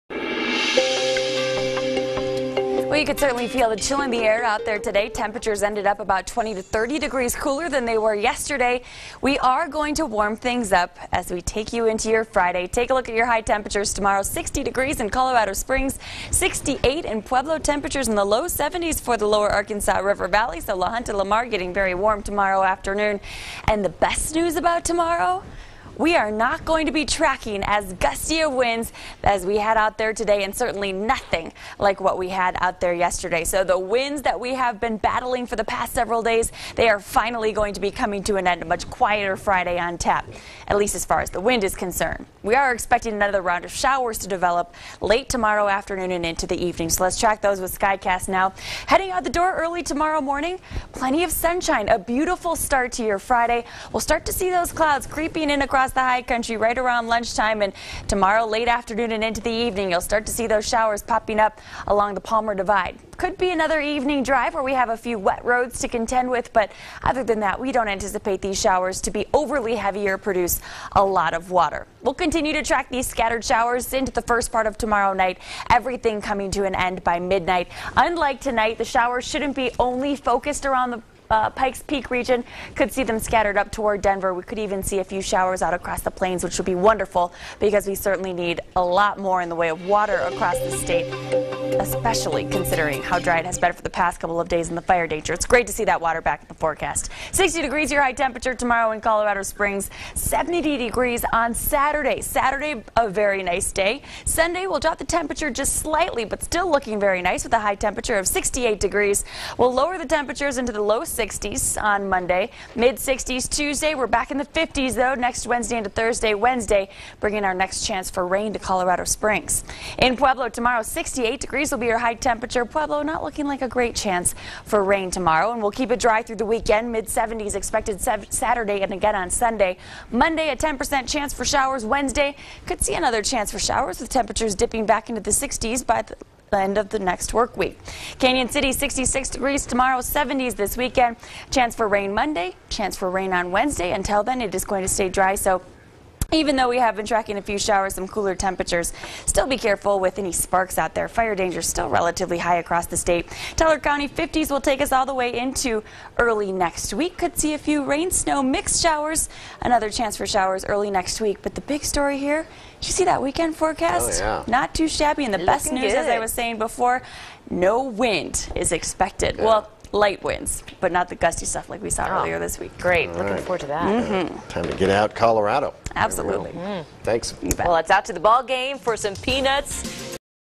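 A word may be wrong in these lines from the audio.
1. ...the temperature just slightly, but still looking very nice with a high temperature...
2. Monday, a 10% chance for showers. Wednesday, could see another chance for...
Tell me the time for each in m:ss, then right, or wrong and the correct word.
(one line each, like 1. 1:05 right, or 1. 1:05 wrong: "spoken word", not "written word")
1. 1:44 right
2. 2:10 right.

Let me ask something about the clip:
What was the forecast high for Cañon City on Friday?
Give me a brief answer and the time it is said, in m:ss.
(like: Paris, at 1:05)
66 degrees, at 2:18.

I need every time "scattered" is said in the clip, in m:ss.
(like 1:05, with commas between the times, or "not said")
1:13, 1:23.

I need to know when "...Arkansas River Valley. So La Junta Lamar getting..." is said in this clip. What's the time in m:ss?
0:19.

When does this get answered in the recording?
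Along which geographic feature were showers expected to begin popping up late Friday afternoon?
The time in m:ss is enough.
1:02.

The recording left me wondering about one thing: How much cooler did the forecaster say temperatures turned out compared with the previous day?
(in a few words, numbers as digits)
20 to 30 degrees.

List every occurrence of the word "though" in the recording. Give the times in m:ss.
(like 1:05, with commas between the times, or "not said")
1:54, 2:26.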